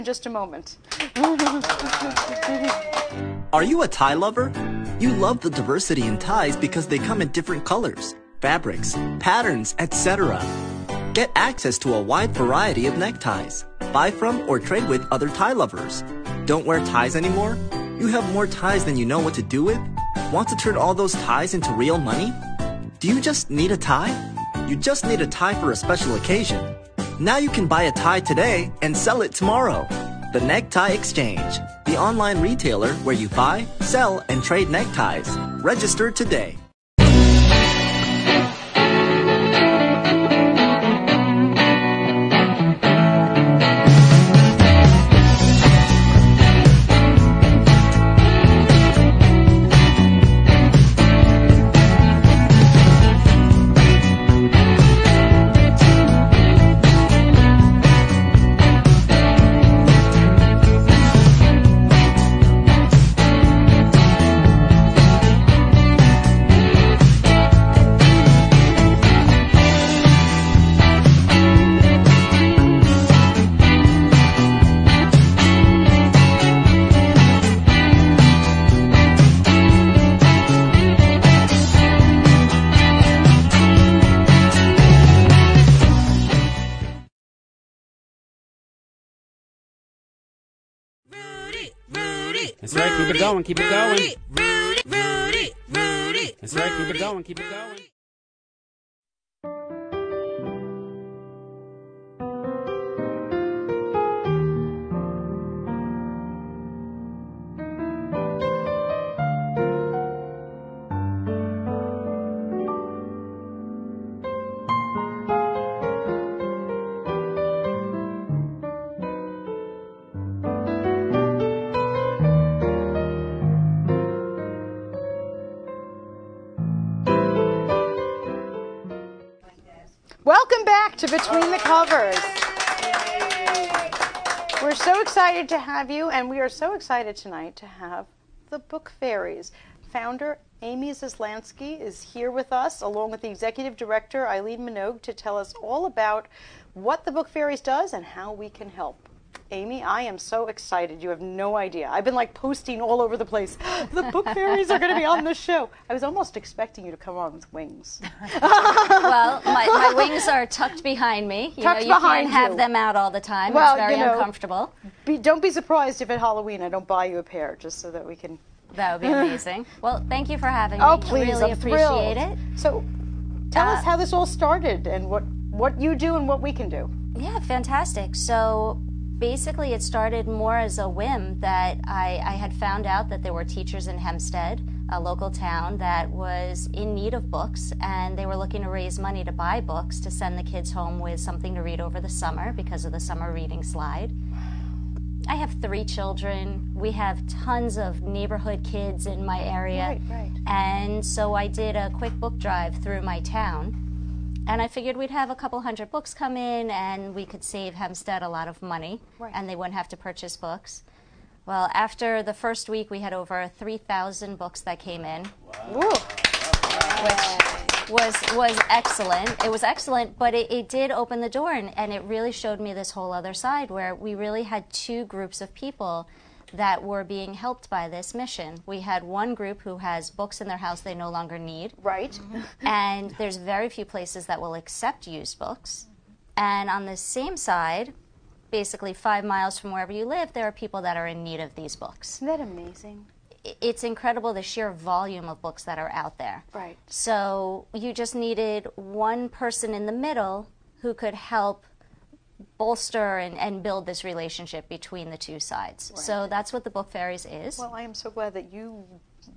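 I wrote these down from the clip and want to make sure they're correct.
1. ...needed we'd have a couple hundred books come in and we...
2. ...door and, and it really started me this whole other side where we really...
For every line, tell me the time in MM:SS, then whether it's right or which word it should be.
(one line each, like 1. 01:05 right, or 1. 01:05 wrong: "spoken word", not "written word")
1. 03:24 wrong: "figured", not "needed"
2. 03:41 wrong: "showed", not "started".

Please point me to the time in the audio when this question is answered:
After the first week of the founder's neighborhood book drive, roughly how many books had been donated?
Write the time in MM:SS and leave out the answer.
03:33.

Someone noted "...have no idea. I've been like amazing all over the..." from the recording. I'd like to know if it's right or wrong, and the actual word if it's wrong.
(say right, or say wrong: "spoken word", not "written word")
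wrong: "posting", not "amazing".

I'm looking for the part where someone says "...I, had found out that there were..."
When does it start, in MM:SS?
03:02.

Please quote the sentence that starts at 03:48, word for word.
We had one group who has books in their house they no longer need.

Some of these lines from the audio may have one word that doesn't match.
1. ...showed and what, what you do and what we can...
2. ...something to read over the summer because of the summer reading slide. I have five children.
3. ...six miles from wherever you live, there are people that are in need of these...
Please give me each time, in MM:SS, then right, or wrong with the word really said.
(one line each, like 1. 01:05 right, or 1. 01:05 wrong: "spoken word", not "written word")
1. 02:54 wrong: "started", not "showed"
2. 03:11 wrong: "three", not "five"
3. 03:58 wrong: "five", not "six".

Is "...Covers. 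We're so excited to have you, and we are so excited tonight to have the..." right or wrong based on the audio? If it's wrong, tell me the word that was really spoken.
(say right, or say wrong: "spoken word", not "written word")
right.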